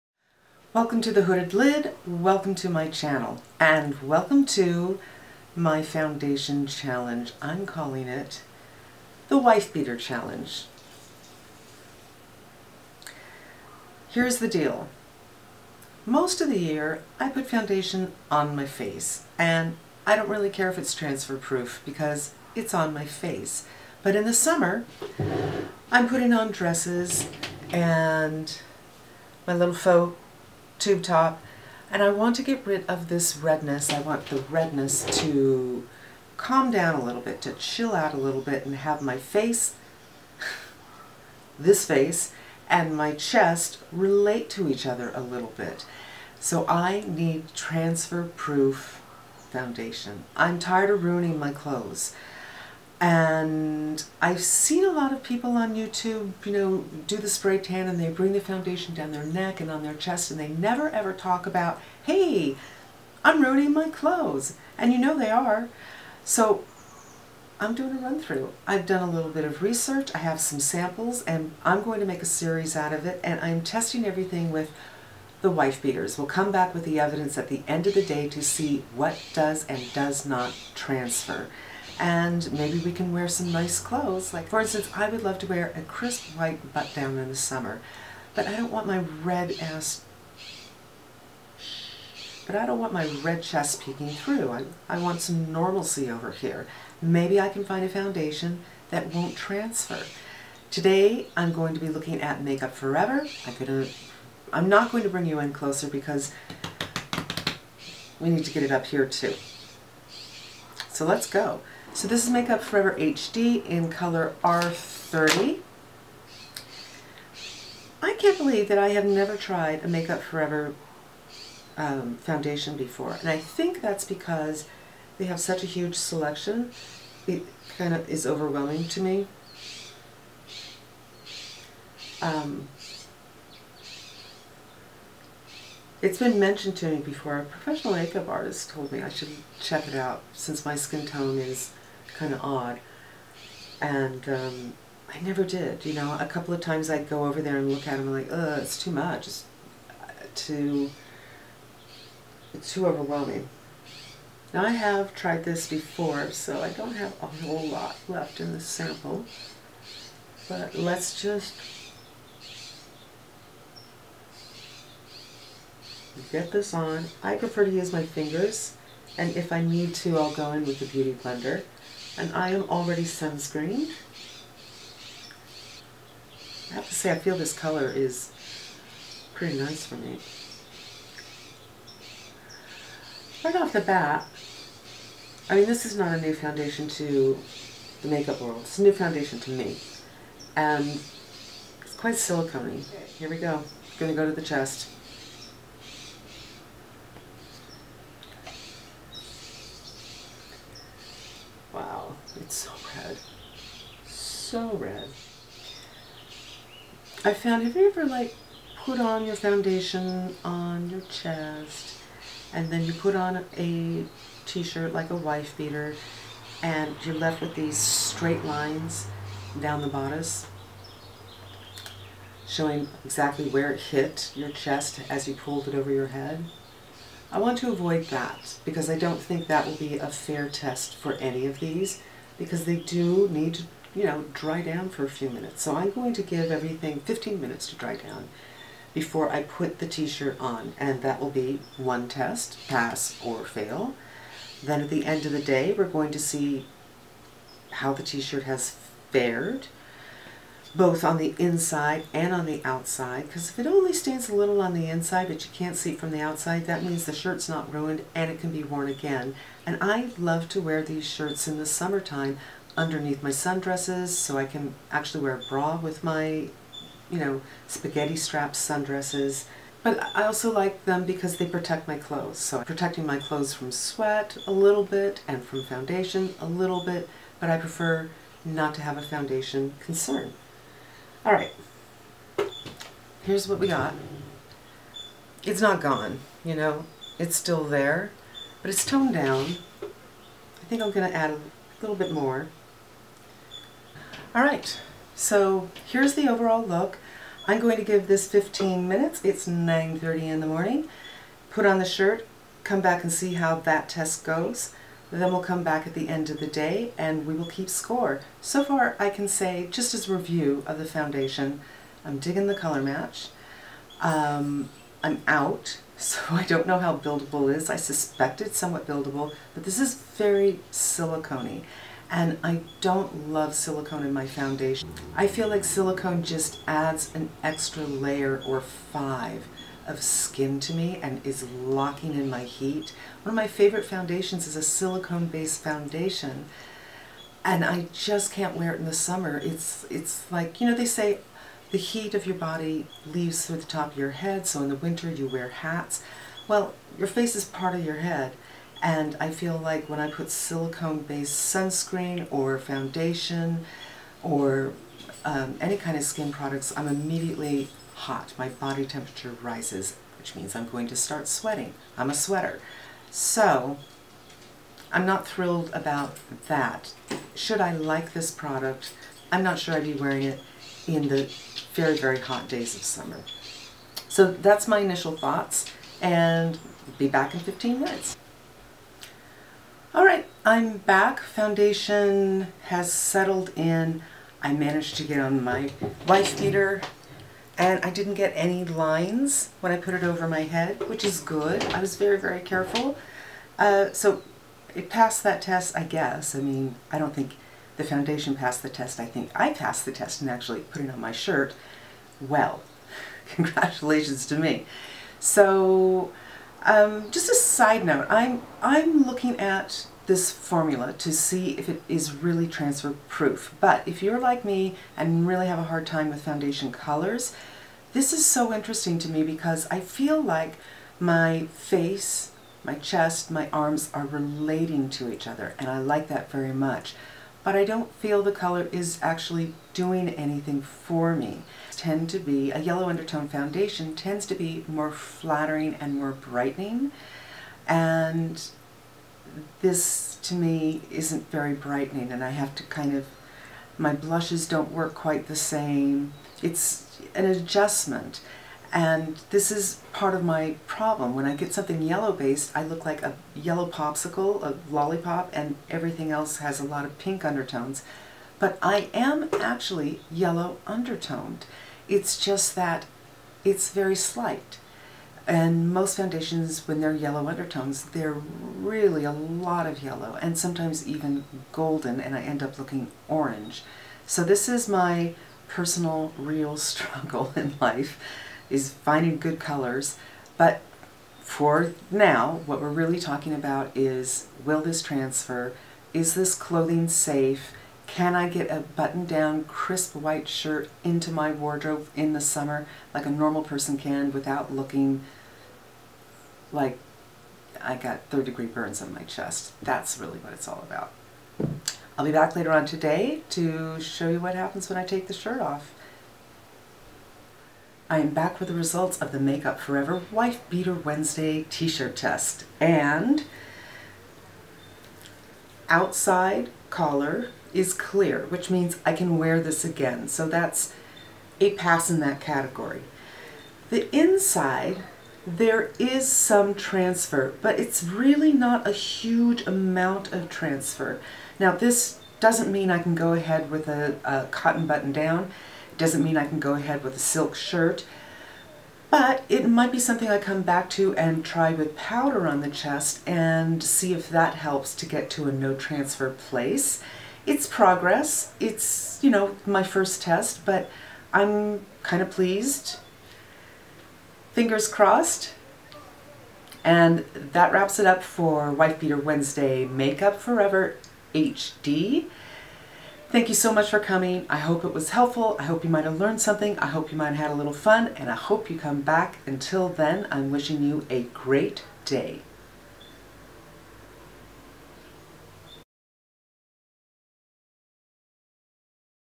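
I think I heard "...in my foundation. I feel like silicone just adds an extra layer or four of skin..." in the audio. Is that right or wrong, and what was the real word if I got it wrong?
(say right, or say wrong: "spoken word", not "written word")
wrong: "five", not "four".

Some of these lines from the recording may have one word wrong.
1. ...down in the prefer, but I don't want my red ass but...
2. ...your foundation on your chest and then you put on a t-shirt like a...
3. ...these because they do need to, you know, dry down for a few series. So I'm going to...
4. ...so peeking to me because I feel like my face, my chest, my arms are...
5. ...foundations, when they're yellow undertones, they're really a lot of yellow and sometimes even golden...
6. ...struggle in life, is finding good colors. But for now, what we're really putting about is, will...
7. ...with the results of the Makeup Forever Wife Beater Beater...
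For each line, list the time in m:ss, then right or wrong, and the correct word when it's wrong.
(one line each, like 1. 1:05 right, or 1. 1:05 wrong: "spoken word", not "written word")
1. 1:26 wrong: "summer", not "prefer"
2. 3:29 right
3. 3:51 wrong: "minutes", not "series"
4. 6:58 wrong: "interesting", not "peeking"
5. 7:45 right
6. 7:56 wrong: "talking", not "putting"
7. 8:28 wrong: "Wednesday", not "Beater".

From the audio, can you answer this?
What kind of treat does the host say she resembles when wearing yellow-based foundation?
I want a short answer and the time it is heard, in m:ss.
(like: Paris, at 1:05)
yellow popsicle, at 7:33.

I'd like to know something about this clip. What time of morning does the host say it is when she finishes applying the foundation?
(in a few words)
9:30.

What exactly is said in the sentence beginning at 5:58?
My body temperature rises, which means I'm going to start sweating.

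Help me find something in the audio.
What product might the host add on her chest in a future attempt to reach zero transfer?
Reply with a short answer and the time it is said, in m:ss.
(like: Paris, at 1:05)
powder, at 9:01.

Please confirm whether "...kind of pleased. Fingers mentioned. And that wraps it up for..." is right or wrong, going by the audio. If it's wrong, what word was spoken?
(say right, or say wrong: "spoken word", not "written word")
wrong: "crossed", not "mentioned".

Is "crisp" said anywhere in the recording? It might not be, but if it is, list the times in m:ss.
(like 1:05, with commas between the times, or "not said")
1:25, 8:09.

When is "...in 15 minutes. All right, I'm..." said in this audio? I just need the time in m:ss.
6:17.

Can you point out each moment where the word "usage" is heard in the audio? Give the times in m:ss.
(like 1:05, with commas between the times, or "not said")
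not said.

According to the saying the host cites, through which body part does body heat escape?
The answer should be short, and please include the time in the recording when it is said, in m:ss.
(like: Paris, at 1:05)
top of your head, at 5:43.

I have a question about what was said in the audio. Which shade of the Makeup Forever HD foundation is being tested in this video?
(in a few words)
R30.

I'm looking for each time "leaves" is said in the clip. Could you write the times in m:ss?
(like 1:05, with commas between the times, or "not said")
5:43.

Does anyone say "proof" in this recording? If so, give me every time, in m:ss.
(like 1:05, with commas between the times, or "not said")
0:21, 0:48, 6:53.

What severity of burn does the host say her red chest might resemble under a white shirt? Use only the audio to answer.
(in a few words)
third-degree.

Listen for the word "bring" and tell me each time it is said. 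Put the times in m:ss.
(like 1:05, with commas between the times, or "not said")
0:58, 1:45.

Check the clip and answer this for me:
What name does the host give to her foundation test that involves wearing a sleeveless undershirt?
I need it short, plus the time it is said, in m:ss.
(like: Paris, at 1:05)
Wife Beater Challenge, at 0:09.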